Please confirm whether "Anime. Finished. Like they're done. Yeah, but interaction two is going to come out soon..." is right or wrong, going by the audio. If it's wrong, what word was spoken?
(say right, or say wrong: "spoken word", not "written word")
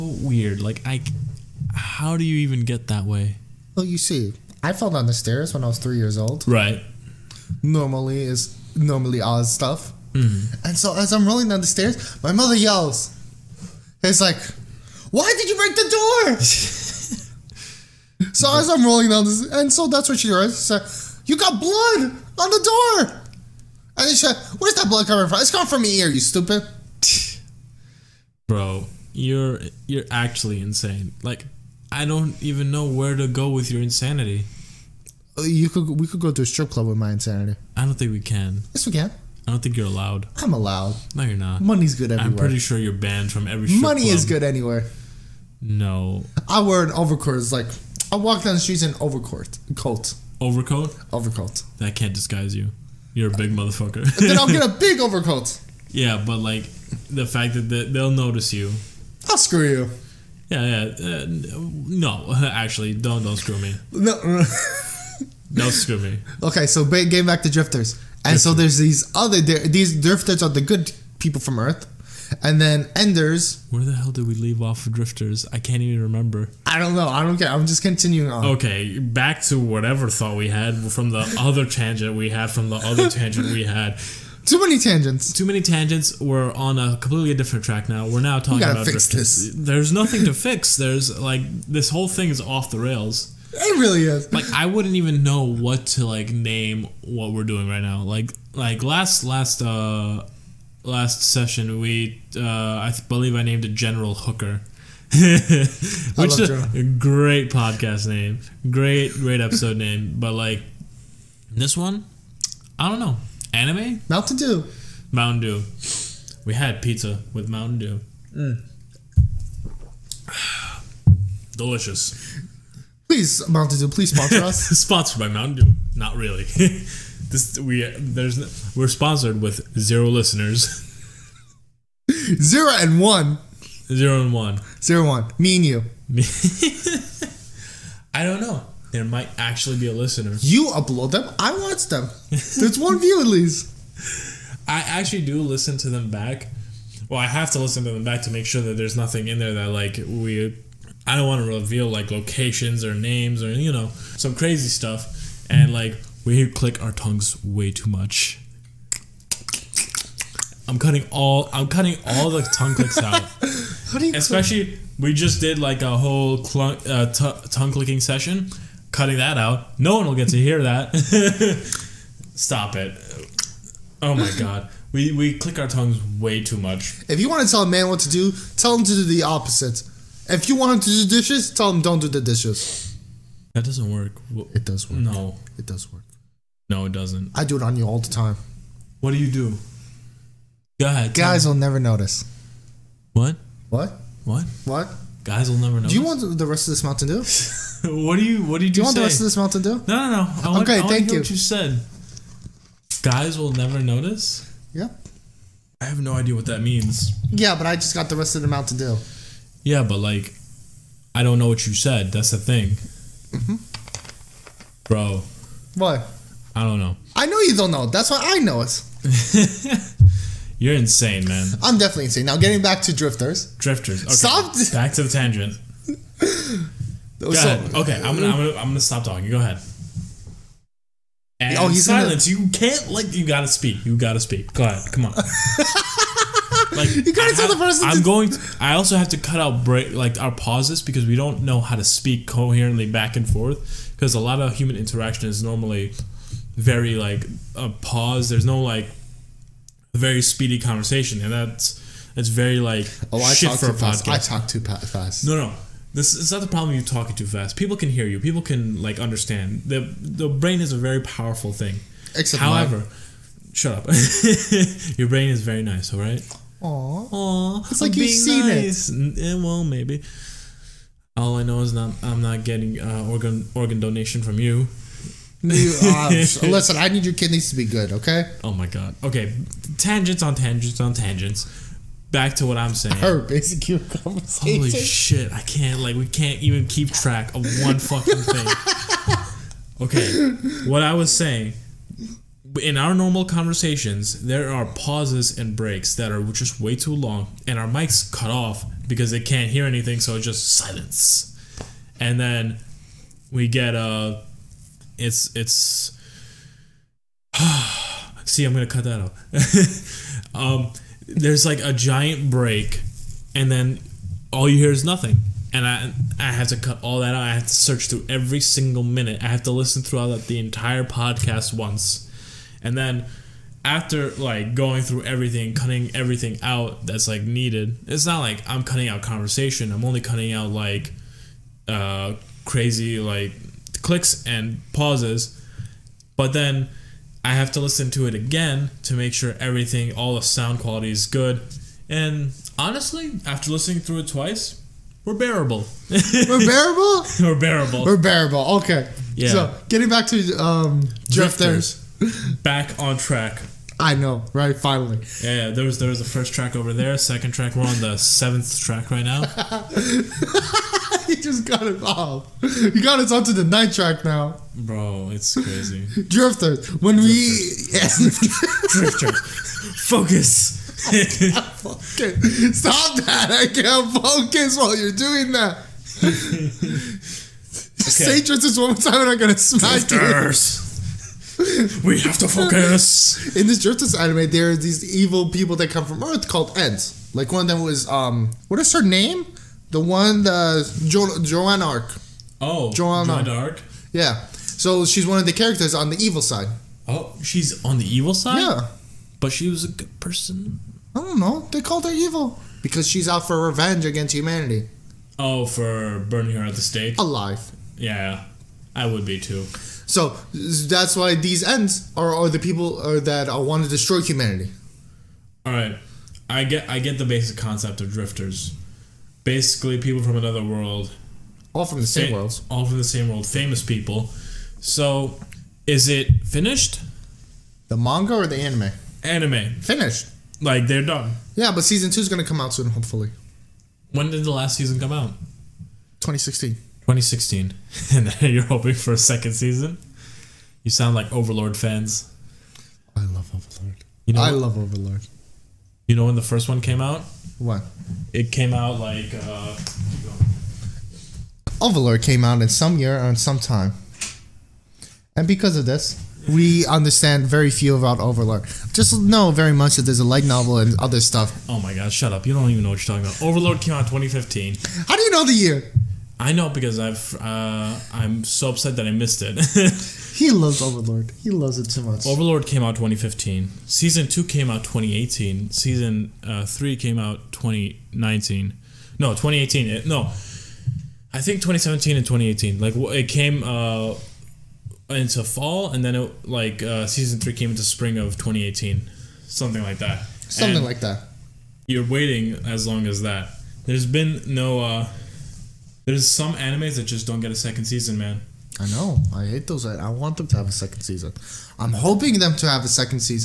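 wrong: "season", not "interaction".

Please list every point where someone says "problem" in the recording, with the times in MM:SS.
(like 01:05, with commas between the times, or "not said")
04:16.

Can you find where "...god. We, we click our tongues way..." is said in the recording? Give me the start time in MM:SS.
02:54.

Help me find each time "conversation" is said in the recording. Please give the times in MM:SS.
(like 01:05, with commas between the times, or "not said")
04:10, 04:43, 04:53, 05:29.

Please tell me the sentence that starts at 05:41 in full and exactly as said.
And honestly, after listening through it twice, we're bearable.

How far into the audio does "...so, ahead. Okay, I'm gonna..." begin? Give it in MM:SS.
03:47.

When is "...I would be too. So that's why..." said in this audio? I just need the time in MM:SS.
06:48.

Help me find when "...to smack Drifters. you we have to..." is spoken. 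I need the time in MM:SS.
06:19.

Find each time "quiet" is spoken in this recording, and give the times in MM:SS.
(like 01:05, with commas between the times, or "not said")
not said.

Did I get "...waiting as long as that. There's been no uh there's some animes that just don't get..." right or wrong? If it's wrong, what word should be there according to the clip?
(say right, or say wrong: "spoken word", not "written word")
right.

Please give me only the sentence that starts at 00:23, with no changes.
And she said, where's that blood coming from?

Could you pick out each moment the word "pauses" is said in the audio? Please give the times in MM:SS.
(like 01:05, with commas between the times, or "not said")
04:00, 04:07, 04:54, 05:34.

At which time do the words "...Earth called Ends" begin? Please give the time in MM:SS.
06:26.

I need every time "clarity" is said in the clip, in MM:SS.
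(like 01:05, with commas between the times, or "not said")
not said.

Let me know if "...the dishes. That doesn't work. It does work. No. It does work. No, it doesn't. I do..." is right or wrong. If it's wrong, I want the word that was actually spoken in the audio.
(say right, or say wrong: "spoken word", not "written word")
right.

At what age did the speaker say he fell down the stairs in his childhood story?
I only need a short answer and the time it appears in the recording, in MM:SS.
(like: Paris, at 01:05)
3, at 00:05.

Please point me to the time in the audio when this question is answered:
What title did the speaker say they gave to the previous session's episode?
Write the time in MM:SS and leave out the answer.
01:43.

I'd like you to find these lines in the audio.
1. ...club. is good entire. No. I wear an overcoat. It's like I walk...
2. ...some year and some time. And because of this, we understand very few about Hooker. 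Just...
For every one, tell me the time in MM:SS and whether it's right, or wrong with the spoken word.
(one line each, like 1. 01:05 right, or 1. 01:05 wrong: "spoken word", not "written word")
1. 00:44 wrong: "anywhere", not "entire"
2. 07:32 wrong: "Overlord", not "Hooker".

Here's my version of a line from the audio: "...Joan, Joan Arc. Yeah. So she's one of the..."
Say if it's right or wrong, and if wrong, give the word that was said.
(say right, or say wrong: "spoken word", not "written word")
right.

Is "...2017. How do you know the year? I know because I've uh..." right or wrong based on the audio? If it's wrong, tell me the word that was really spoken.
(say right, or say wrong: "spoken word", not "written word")
wrong: "2015", not "2017".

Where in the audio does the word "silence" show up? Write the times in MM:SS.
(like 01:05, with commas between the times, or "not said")
03:51, 05:00.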